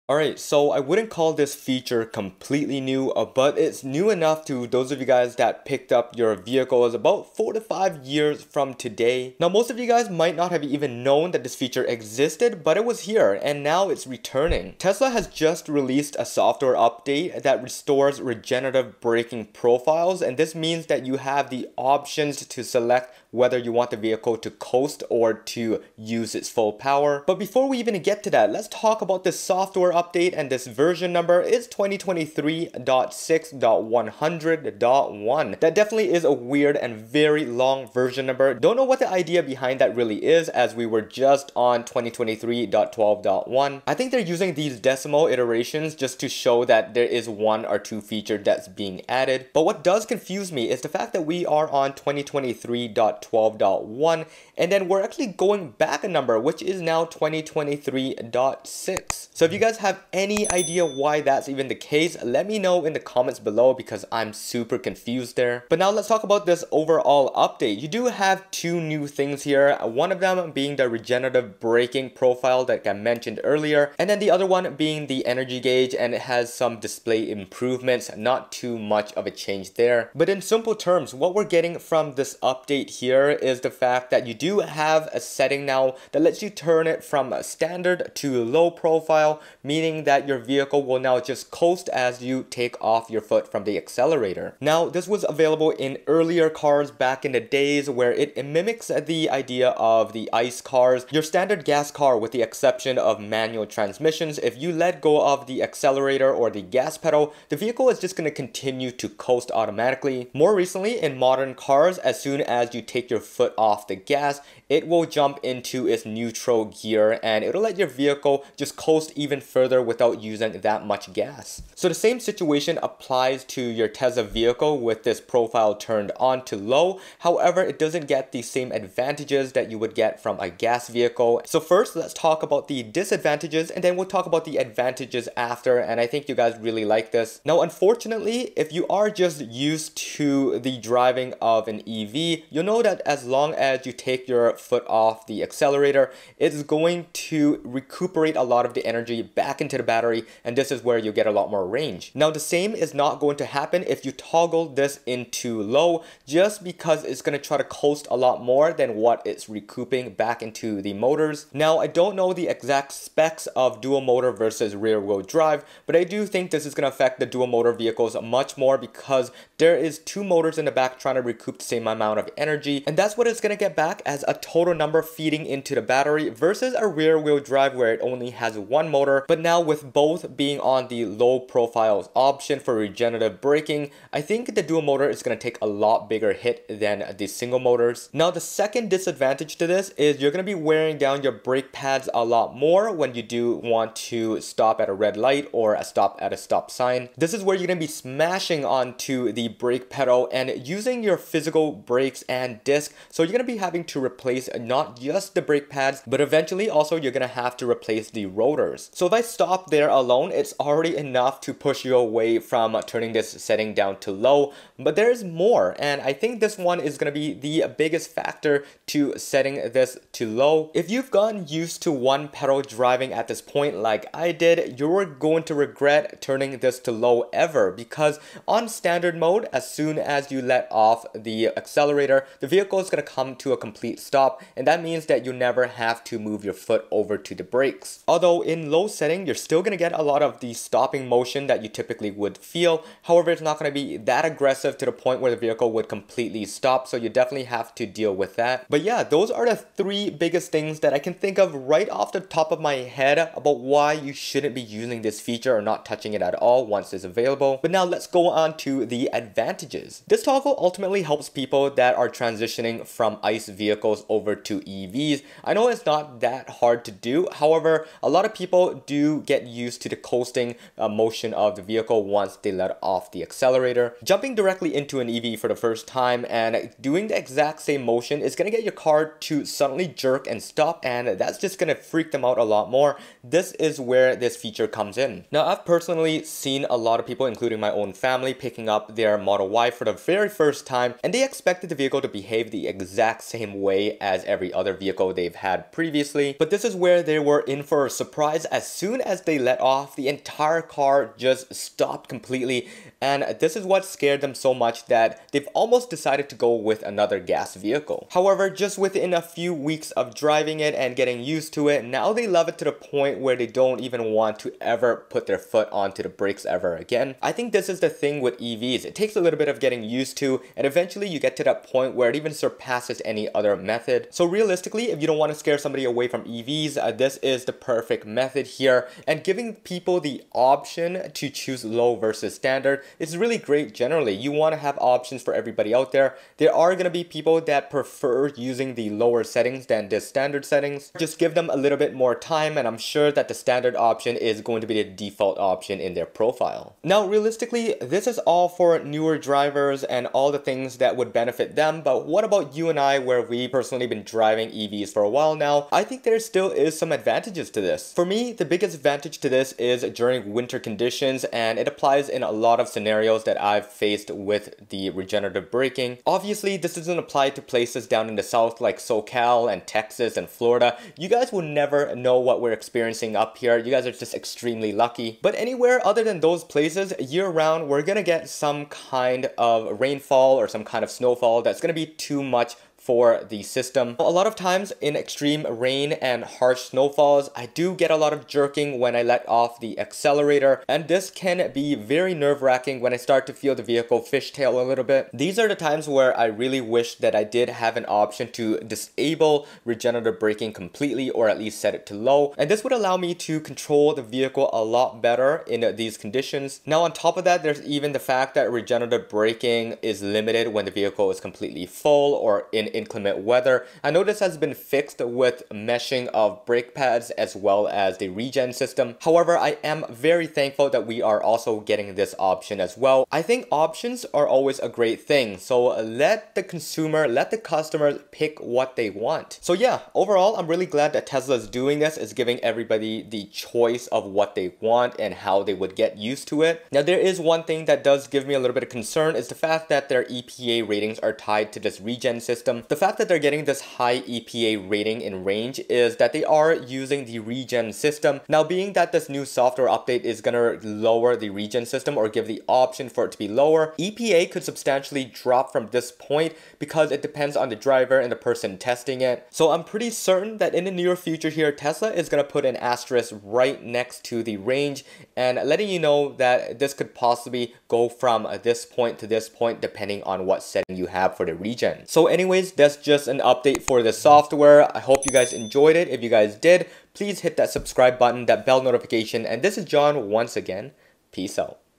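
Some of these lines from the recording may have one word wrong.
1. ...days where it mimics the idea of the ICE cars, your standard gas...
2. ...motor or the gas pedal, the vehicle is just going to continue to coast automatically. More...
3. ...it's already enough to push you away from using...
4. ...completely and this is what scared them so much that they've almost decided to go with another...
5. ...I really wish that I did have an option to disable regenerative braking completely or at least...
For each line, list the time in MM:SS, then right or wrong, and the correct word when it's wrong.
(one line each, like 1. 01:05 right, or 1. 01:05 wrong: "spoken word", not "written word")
1. 01:37 right
2. 01:45 wrong: "accelerator", not "motor"
3. 03:30 wrong: "turning", not "using"
4. 05:02 right
5. 06:36 right.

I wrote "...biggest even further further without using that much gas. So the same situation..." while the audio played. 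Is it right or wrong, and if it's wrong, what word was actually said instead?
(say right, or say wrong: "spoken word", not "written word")
wrong: "coast", not "biggest".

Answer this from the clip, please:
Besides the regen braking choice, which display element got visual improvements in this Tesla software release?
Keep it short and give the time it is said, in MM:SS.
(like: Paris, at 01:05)
energy gauge, at 01:15.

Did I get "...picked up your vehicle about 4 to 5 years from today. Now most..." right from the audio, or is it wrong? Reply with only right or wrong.
right.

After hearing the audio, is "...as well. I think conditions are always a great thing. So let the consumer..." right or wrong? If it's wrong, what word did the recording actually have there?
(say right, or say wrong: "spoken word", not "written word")
wrong: "options", not "conditions".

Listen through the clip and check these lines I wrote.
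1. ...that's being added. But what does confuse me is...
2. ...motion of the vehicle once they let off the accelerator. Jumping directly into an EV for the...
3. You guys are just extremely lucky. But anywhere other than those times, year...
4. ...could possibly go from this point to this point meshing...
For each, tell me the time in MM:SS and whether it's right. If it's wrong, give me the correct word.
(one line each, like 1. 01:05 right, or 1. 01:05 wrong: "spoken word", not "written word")
1. 00:48 right
2. 04:30 right
3. 06:13 wrong: "places", not "times"
4. 07:46 wrong: "depending", not "meshing".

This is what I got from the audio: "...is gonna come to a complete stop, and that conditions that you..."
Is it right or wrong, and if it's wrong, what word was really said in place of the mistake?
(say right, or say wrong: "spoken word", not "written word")
wrong: "means", not "conditions".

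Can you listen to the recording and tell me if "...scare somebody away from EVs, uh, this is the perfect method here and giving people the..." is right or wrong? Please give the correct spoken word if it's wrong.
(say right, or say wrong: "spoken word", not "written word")
right.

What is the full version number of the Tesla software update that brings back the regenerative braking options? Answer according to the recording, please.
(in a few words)
2023.6.100.1.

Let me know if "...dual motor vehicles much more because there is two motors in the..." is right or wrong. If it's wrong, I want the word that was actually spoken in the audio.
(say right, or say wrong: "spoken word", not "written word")
right.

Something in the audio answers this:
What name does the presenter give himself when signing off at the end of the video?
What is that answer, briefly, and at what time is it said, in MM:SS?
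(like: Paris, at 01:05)
John, at 07:59.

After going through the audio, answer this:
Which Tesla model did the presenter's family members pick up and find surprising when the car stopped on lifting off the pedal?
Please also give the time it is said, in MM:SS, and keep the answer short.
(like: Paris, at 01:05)
Model Y, at 04:49.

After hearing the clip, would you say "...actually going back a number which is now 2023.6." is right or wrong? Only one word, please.
right.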